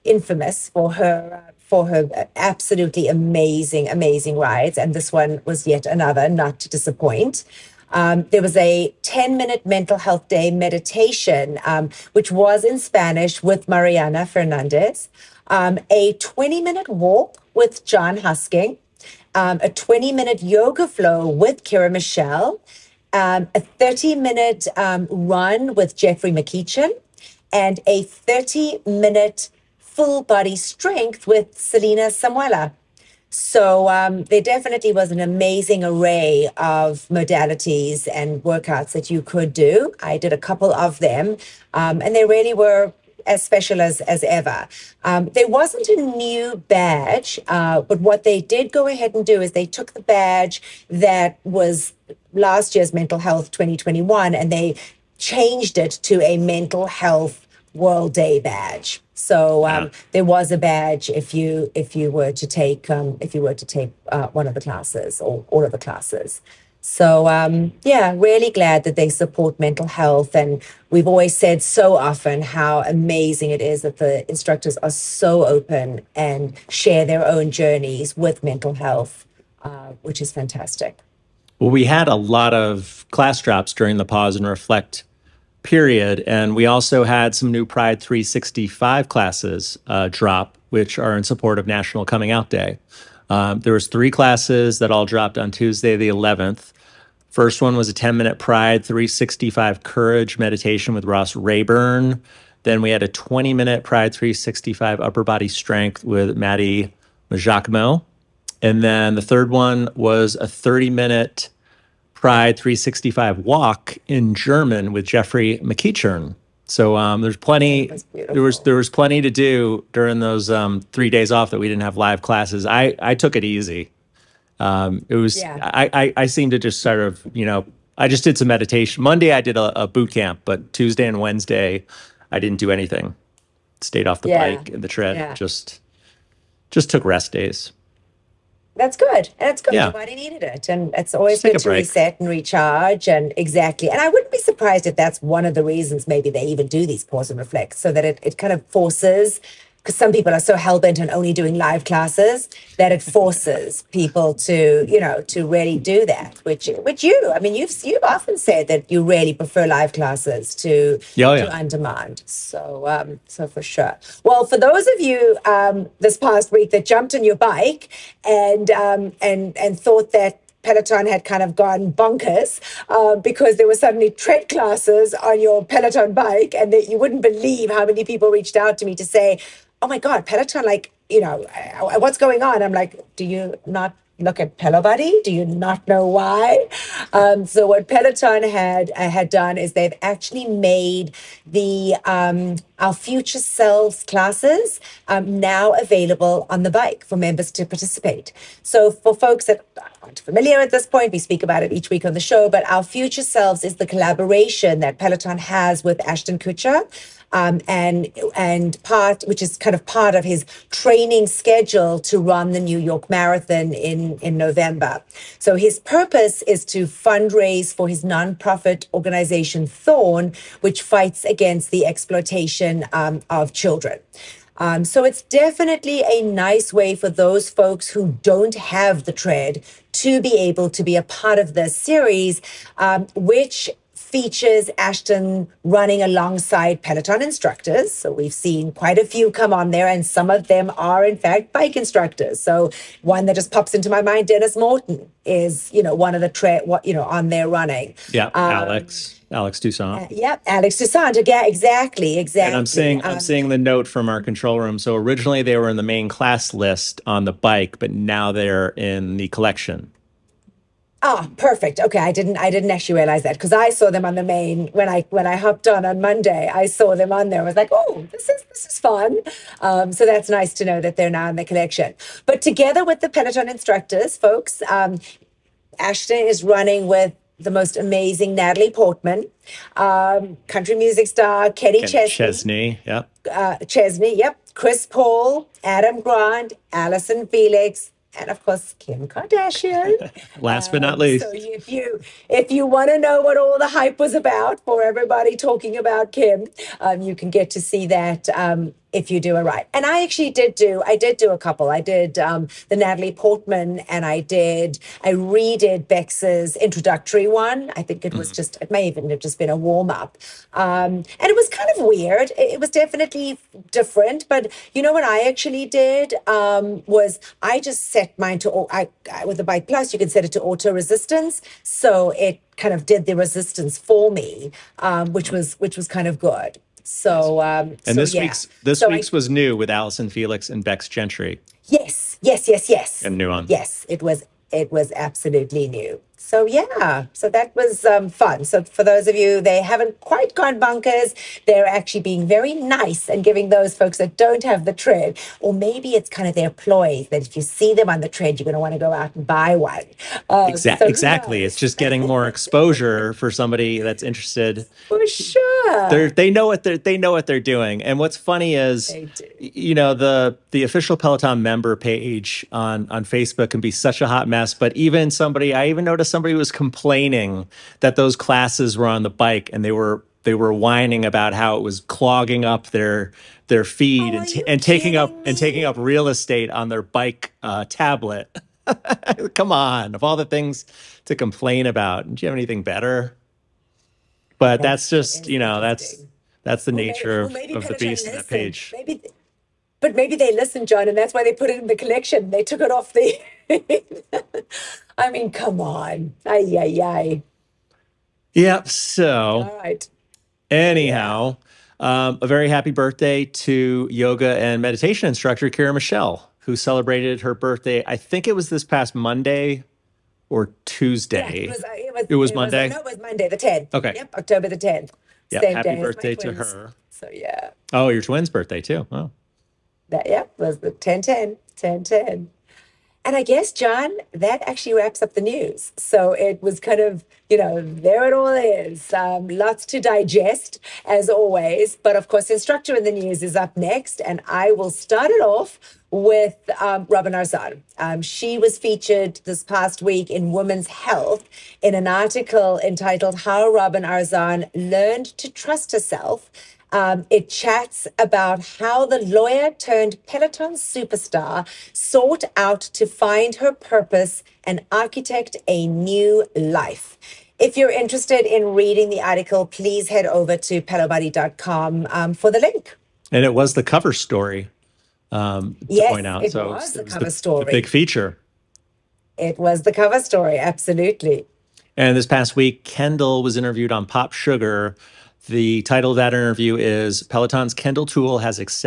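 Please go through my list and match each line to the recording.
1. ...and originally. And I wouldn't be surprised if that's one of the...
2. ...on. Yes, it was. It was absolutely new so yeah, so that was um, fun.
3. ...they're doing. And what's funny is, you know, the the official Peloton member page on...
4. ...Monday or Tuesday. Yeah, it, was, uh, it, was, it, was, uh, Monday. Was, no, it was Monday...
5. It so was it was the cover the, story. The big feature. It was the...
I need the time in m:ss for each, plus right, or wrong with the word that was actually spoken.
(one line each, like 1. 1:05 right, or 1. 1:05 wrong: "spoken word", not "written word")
1. 2:23 wrong: "exactly", not "originally"
2. 5:33 right
3. 5:57 right
4. 6:48 right
5. 7:46 right.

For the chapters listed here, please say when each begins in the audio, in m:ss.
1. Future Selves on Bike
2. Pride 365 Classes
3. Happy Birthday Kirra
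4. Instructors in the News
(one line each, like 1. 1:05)
1. 2:42
2. 1:20
3. 6:36
4. 7:00.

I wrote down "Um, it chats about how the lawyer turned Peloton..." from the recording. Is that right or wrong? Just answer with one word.
right.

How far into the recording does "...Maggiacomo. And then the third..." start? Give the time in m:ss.
1:47.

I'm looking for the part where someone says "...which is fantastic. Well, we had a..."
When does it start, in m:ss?
1:20.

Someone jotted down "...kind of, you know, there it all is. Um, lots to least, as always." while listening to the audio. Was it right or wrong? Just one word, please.
wrong.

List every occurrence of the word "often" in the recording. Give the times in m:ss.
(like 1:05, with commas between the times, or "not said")
1:11, 2:38.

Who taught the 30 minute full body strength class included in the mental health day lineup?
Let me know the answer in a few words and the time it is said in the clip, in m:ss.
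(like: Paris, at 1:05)
Selena Samuela, at 0:31.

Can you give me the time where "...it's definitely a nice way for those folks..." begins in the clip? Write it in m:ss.
3:45.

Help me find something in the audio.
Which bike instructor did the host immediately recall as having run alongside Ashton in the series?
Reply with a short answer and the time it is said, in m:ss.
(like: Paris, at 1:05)
Denis Morton, at 4:04.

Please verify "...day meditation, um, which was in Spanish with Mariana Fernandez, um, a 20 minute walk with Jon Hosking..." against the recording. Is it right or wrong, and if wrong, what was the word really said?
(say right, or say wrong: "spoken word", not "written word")
right.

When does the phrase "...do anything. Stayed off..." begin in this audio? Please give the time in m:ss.
2:12.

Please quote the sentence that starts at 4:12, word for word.
And I'm seeing um, I'm seeing the note from our control room.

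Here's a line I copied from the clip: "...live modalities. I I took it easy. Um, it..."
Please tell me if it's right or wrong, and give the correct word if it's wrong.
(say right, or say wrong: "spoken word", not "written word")
wrong: "classes", not "modalities".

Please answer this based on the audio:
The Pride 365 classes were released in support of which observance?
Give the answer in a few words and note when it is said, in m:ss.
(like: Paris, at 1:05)
National Coming Out Day, at 1:31.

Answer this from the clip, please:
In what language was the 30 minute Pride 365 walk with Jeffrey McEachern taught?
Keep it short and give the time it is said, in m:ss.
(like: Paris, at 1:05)
German, at 1:54.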